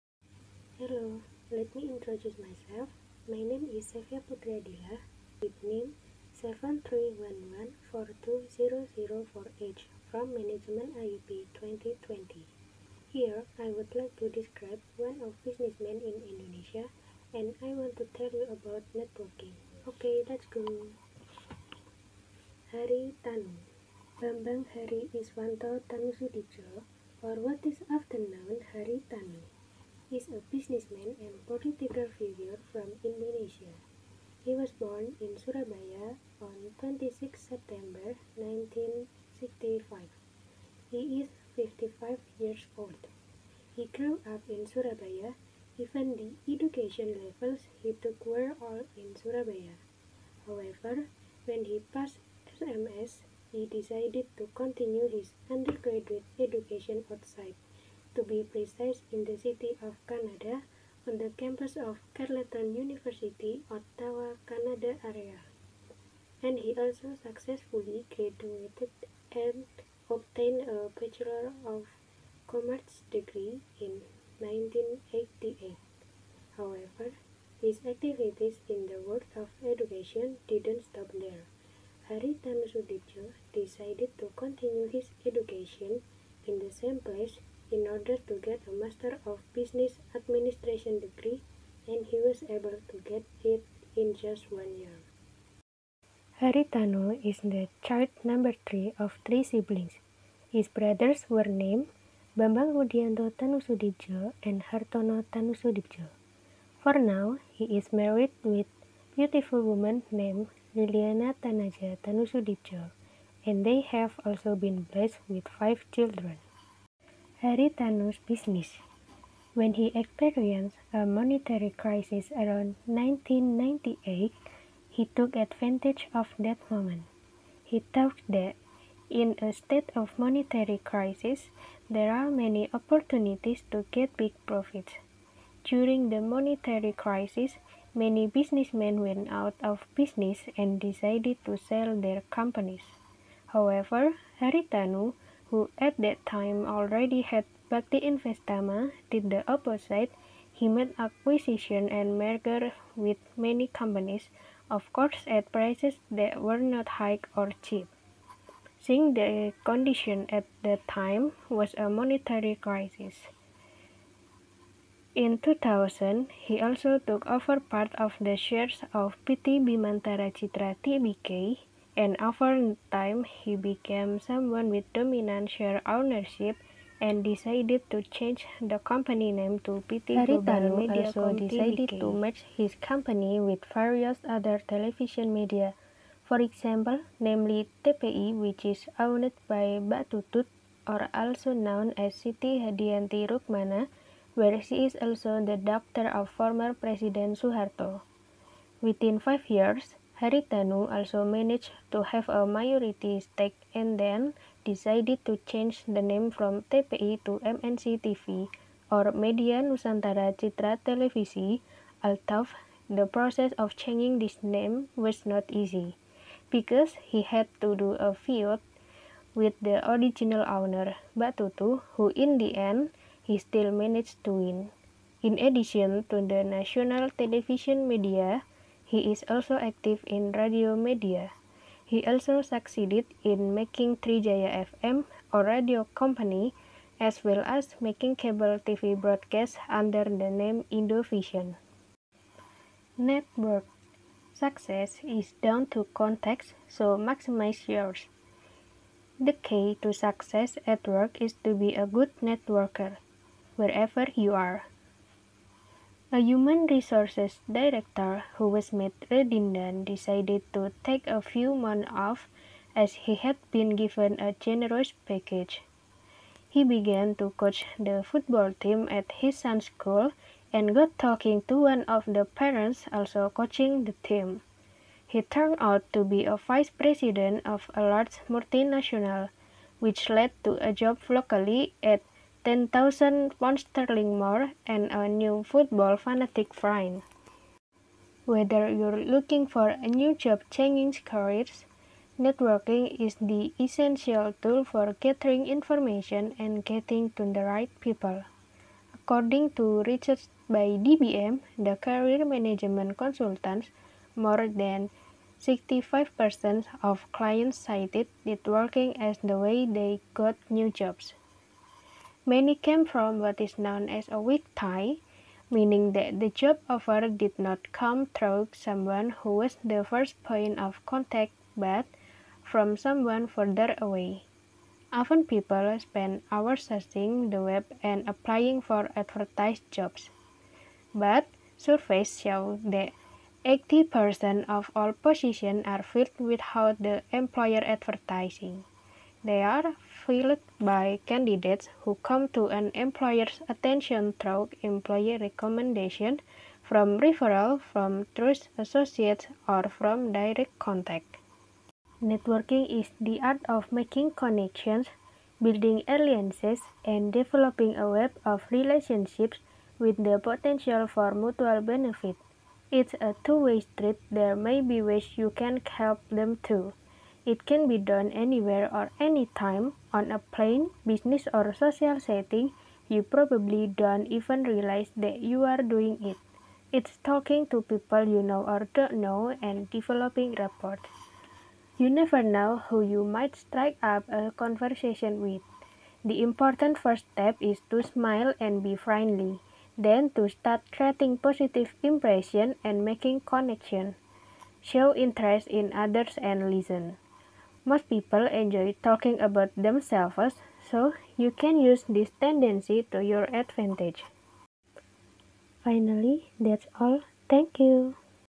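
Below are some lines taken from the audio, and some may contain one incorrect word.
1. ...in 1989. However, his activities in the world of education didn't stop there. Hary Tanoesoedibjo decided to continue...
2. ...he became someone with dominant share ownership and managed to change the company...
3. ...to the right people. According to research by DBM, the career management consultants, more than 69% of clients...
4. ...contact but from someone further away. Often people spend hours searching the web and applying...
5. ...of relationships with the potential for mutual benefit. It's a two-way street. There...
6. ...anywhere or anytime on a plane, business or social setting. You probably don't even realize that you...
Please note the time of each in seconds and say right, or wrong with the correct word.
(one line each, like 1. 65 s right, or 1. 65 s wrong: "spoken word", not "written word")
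1. 73 s wrong: "1988", not "1989"
2. 173 s wrong: "decided", not "managed"
3. 297 s wrong: "65", not "69"
4. 320 s right
5. 358 s right
6. 368 s right.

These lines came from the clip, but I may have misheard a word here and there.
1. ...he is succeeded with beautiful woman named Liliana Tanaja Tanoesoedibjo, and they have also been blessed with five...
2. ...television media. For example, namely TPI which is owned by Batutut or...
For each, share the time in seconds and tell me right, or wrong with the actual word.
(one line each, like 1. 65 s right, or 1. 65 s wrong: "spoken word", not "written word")
1. 107 s wrong: "married", not "succeeded"
2. 184 s right.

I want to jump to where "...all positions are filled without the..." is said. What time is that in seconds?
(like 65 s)
334 s.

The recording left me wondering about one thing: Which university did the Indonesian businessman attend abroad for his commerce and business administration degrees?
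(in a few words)
Carleton University.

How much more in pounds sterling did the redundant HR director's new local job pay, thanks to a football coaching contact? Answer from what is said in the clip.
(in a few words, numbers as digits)
10,000 pounds sterling.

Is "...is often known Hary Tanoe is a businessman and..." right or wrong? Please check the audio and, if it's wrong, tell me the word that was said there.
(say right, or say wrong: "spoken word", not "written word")
right.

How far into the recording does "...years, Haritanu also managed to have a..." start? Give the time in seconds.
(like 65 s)
199 s.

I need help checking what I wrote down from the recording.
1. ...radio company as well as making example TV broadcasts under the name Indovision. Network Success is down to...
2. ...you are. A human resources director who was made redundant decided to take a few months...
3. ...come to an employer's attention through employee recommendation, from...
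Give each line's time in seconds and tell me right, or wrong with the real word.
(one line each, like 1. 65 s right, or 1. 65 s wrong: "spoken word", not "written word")
1. 235 s wrong: "cable", not "example"
2. 254 s right
3. 342 s right.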